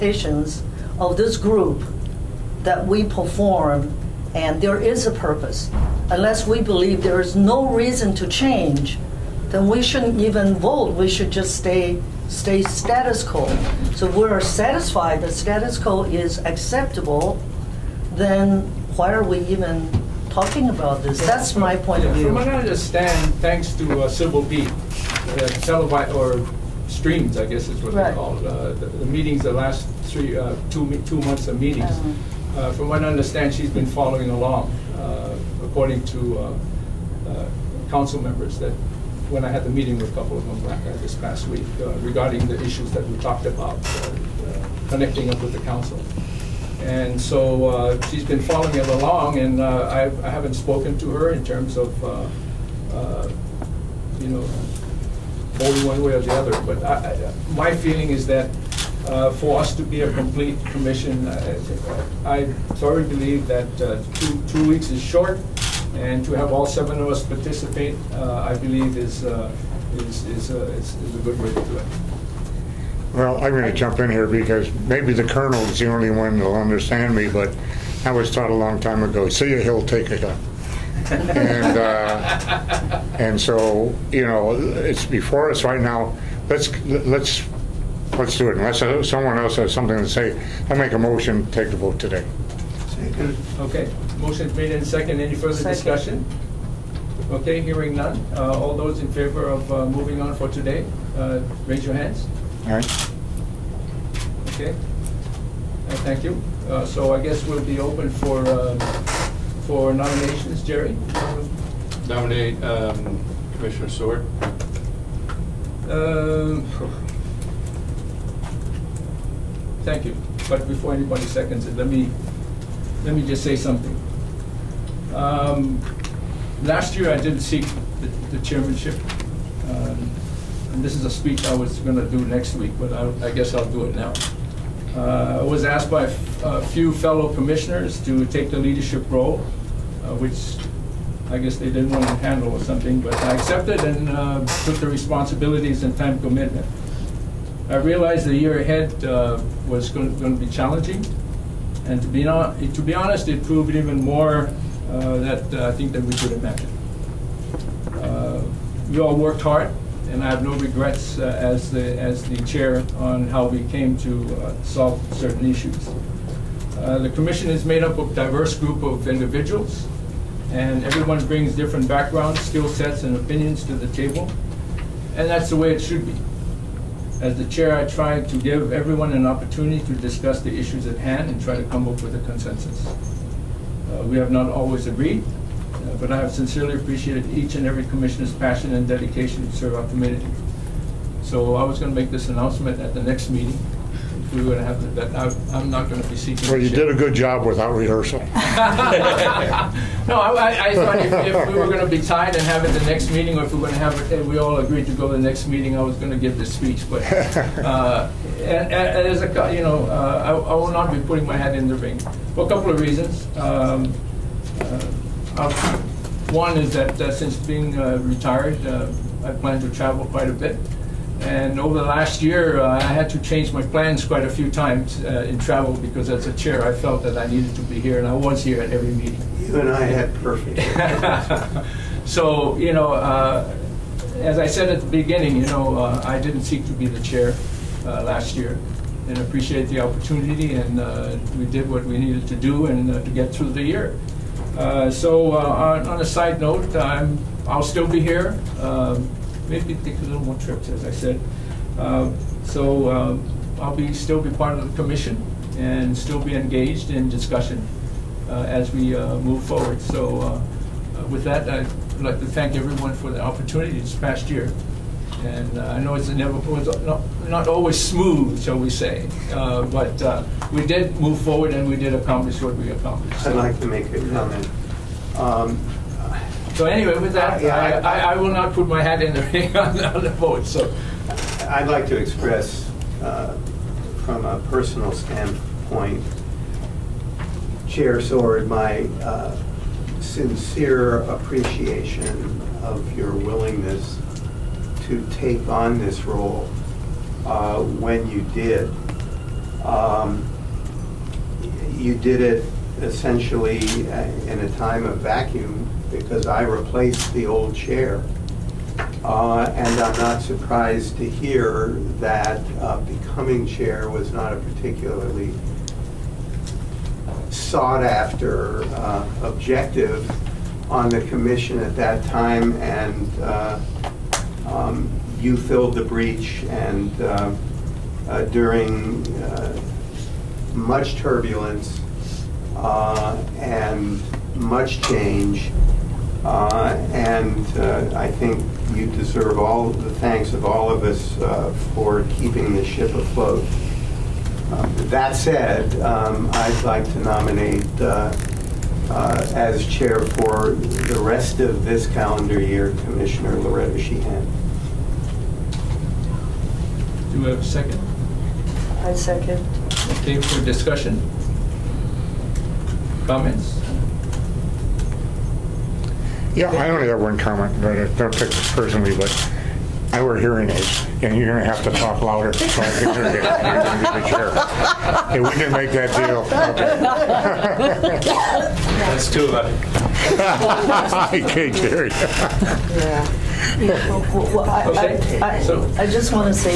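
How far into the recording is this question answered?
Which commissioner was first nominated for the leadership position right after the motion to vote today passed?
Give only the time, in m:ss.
1:53.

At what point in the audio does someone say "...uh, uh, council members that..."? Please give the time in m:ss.
0:36.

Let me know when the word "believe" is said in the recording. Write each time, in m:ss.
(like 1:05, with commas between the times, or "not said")
0:06, 1:03, 1:08.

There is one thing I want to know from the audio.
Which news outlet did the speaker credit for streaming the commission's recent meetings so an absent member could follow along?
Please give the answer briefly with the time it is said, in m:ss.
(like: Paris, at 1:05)
Civil Beat, at 0:24.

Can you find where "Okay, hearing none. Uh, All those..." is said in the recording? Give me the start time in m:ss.
1:37.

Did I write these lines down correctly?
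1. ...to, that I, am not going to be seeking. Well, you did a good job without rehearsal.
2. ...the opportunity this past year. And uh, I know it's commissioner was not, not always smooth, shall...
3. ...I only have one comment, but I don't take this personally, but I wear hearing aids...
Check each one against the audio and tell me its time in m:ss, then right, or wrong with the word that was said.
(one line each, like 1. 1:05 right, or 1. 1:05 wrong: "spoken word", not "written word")
1. 3:14 right
2. 4:23 wrong: "never", not "commissioner"
3. 6:06 right.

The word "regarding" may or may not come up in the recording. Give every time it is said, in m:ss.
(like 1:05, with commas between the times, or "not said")
0:42.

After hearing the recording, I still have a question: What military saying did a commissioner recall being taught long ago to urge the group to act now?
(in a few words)
see a hill, take a gun.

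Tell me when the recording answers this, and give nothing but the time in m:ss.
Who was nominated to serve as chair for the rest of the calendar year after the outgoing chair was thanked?
5:53.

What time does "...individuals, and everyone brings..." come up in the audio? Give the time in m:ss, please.
2:49.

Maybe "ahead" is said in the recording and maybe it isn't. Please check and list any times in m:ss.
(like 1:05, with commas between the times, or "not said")
2:28.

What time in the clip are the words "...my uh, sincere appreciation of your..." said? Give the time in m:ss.
4:48.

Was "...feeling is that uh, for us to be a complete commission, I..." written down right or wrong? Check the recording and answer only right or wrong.
right.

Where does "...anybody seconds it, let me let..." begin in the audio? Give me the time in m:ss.
2:00.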